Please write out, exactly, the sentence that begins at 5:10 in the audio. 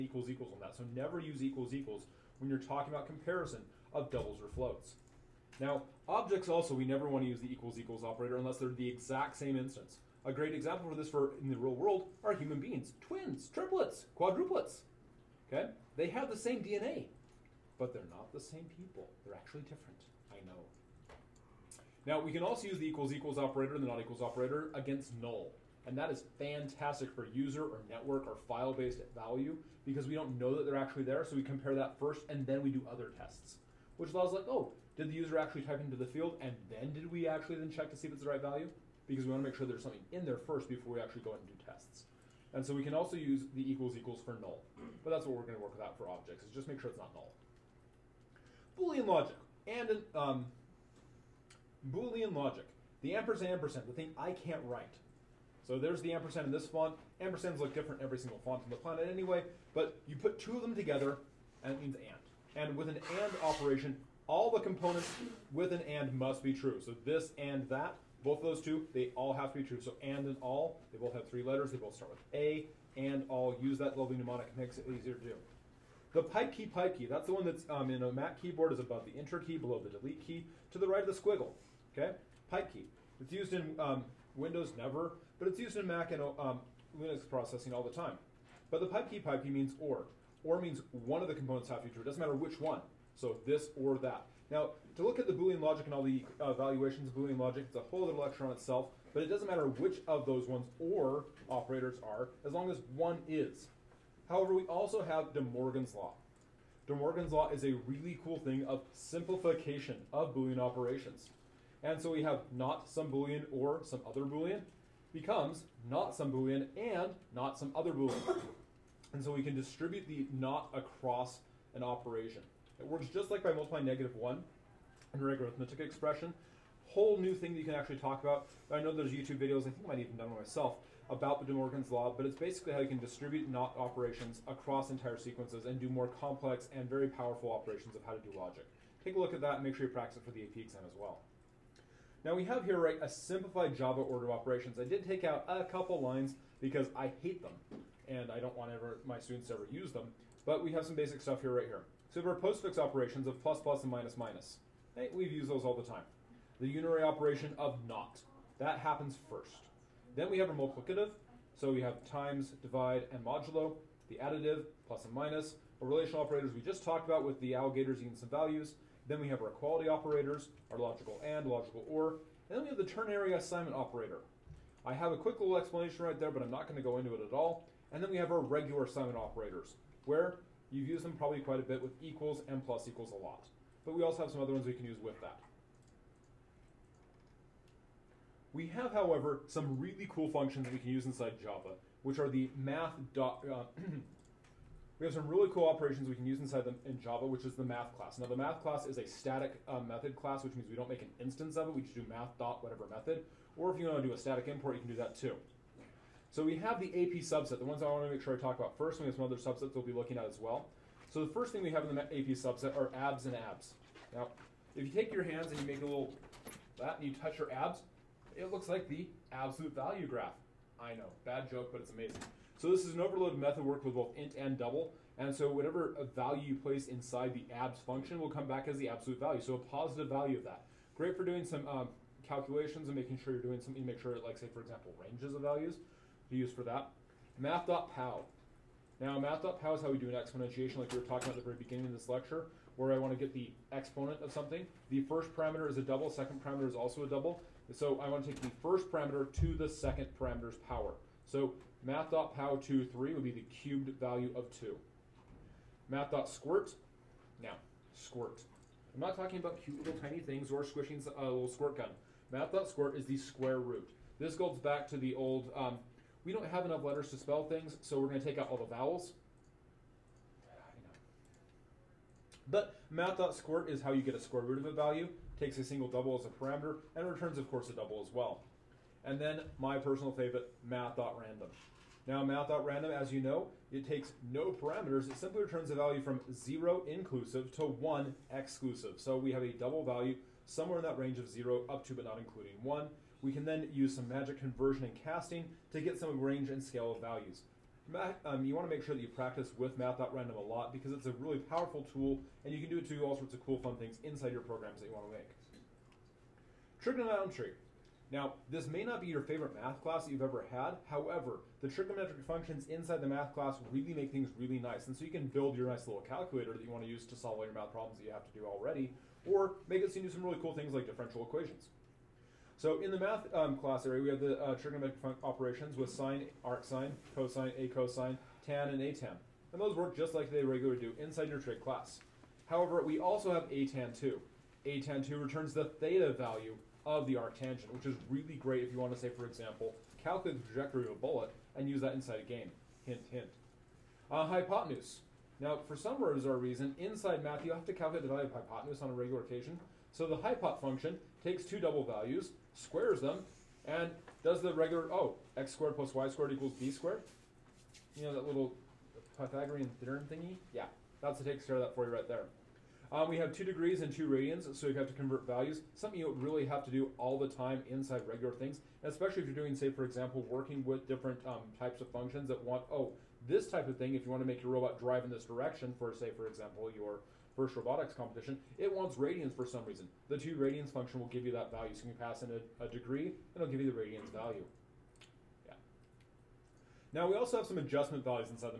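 However, the trigonometric functions inside the math class really make things really nice.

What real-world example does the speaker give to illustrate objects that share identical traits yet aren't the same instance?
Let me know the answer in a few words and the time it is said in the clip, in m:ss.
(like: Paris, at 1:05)
Twins, triplets, quadruplets, at 0:13.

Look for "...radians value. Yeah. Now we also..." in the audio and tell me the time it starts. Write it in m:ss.
6:23.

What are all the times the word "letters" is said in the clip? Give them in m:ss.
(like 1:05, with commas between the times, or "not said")
1:11, 4:26.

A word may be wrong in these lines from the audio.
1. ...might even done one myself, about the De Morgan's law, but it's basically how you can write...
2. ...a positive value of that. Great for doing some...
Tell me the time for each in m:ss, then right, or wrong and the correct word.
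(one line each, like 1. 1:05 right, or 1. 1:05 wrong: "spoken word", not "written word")
1. 2:09 wrong: "distribute", not "write"
2. 3:49 right.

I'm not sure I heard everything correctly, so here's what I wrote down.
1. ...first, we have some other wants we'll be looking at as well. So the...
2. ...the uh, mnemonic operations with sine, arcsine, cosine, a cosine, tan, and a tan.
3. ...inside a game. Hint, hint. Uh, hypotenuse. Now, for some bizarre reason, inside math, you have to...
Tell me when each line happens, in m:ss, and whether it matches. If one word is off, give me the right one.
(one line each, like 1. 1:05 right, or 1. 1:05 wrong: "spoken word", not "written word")
1. 3:28 wrong: "subsets", not "wants"
2. 5:24 wrong: "trigonometric", not "mnemonic"
3. 5:41 right.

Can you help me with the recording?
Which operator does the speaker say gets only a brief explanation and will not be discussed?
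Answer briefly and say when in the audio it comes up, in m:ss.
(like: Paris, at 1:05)
Ternary assignment operator, at 2:52.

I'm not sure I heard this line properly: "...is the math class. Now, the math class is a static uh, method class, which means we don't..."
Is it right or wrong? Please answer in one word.
right.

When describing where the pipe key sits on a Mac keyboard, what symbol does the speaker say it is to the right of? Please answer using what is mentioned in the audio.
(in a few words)
The squiggle.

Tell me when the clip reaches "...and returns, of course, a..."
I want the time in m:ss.
4:36.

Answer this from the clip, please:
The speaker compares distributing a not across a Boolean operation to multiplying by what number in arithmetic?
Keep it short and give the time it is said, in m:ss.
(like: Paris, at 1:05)
-1, at 2:03.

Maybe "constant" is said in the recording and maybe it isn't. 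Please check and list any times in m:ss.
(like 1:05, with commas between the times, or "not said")
not said.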